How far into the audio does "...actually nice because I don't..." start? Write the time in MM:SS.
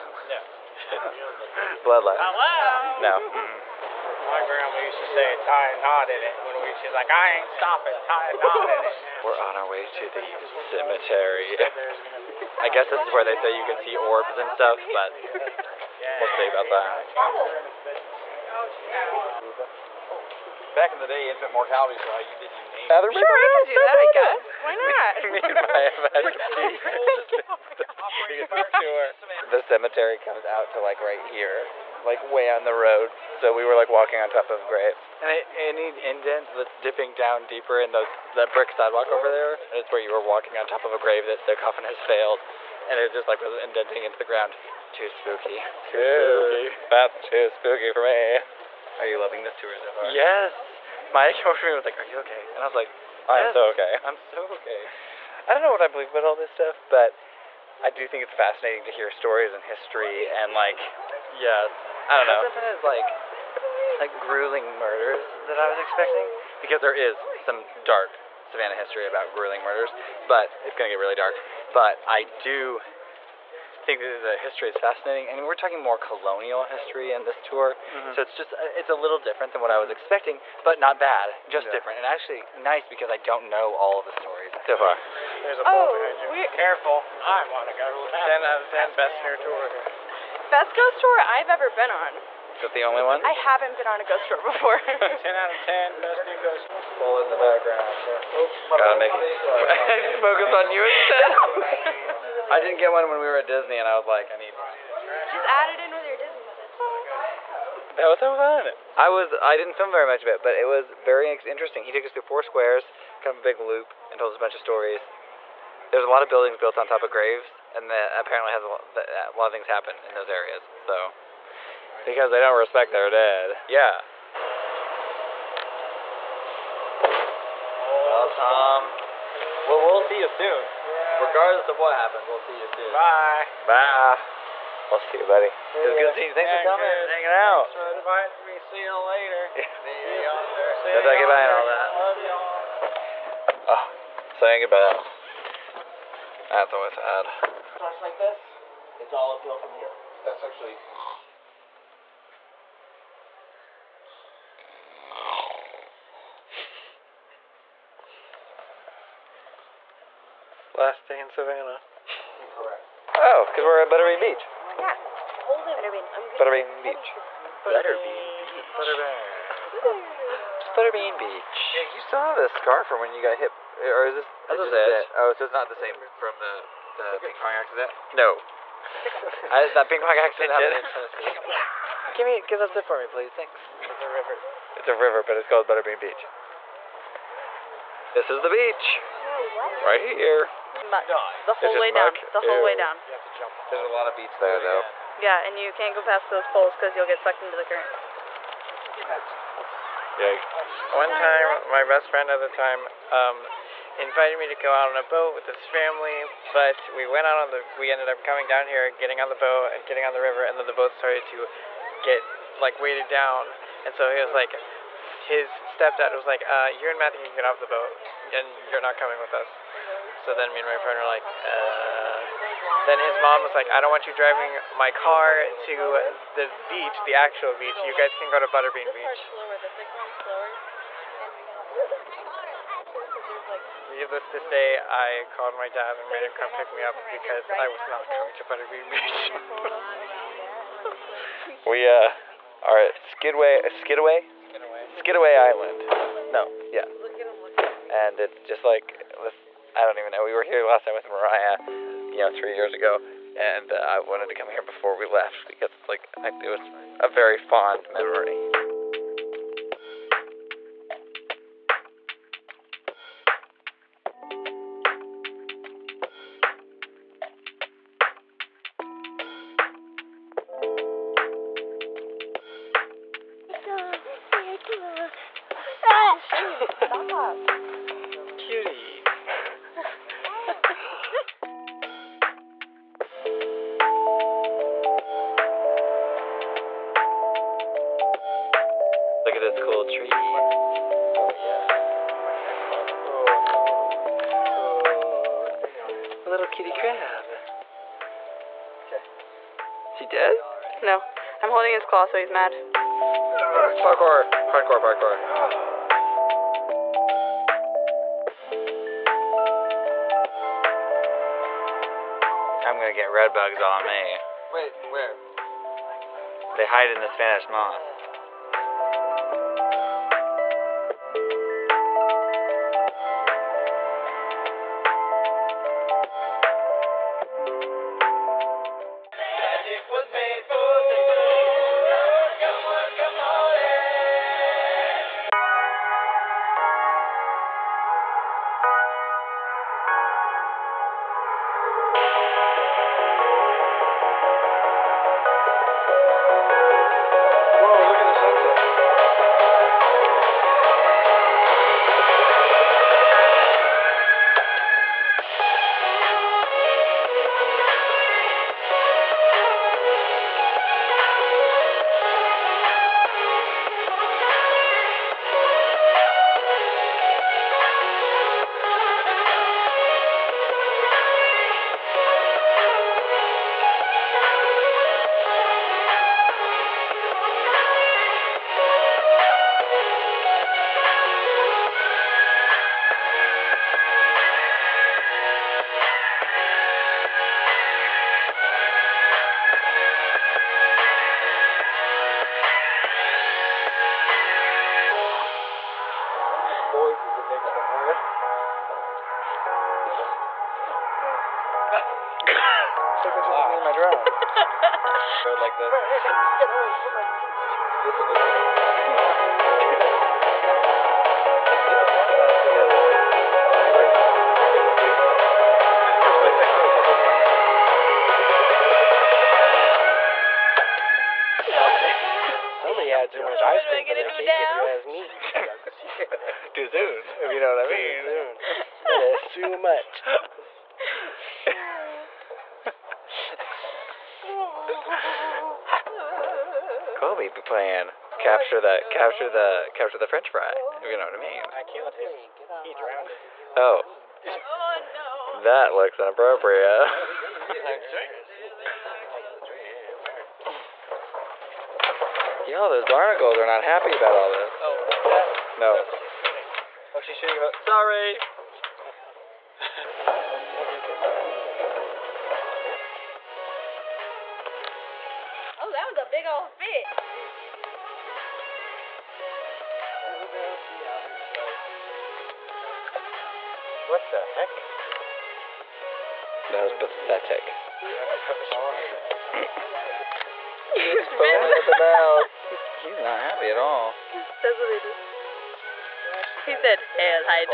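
01:22.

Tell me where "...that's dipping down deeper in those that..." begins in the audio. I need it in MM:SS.
00:36.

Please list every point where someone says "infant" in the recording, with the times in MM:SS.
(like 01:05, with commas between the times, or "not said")
00:21.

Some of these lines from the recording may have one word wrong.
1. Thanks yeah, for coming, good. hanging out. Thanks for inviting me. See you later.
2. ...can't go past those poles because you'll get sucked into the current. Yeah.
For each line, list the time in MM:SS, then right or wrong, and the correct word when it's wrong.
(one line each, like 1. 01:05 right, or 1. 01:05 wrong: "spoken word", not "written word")
1. 02:16 right
2. 03:15 right.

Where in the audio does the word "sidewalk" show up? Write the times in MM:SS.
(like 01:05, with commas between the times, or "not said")
00:38.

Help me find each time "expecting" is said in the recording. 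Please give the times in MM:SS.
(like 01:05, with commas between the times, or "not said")
01:05, 01:20.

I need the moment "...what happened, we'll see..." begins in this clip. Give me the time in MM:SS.
02:11.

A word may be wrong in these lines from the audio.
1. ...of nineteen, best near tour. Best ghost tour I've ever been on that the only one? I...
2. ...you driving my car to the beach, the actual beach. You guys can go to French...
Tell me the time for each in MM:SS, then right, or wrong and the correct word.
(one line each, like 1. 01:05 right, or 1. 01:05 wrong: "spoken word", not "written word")
1. 01:28 wrong: "ten", not "nineteen"
2. 03:44 wrong: "Butterbean", not "French".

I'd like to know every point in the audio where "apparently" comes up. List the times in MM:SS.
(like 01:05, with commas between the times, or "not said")
01:58.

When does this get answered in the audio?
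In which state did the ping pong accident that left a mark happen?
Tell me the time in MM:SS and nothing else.
03:00.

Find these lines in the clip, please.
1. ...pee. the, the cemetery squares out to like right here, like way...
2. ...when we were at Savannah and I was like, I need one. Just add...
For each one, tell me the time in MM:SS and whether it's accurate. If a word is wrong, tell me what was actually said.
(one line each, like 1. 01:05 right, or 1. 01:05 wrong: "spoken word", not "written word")
1. 00:26 wrong: "comes", not "squares"
2. 01:43 wrong: "Disney", not "Savannah".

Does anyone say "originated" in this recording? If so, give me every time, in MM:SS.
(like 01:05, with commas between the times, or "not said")
not said.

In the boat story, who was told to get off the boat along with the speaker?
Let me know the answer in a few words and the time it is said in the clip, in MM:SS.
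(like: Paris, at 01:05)
Matthew, at 03:36.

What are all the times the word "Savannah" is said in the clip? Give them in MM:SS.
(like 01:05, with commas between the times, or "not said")
01:08, 02:41.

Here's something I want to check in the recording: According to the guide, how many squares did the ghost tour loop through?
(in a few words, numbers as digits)
4.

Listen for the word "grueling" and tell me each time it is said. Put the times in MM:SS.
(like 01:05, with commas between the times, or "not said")
01:04, 01:09.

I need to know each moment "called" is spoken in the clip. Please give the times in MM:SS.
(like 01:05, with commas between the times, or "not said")
03:05, 03:55.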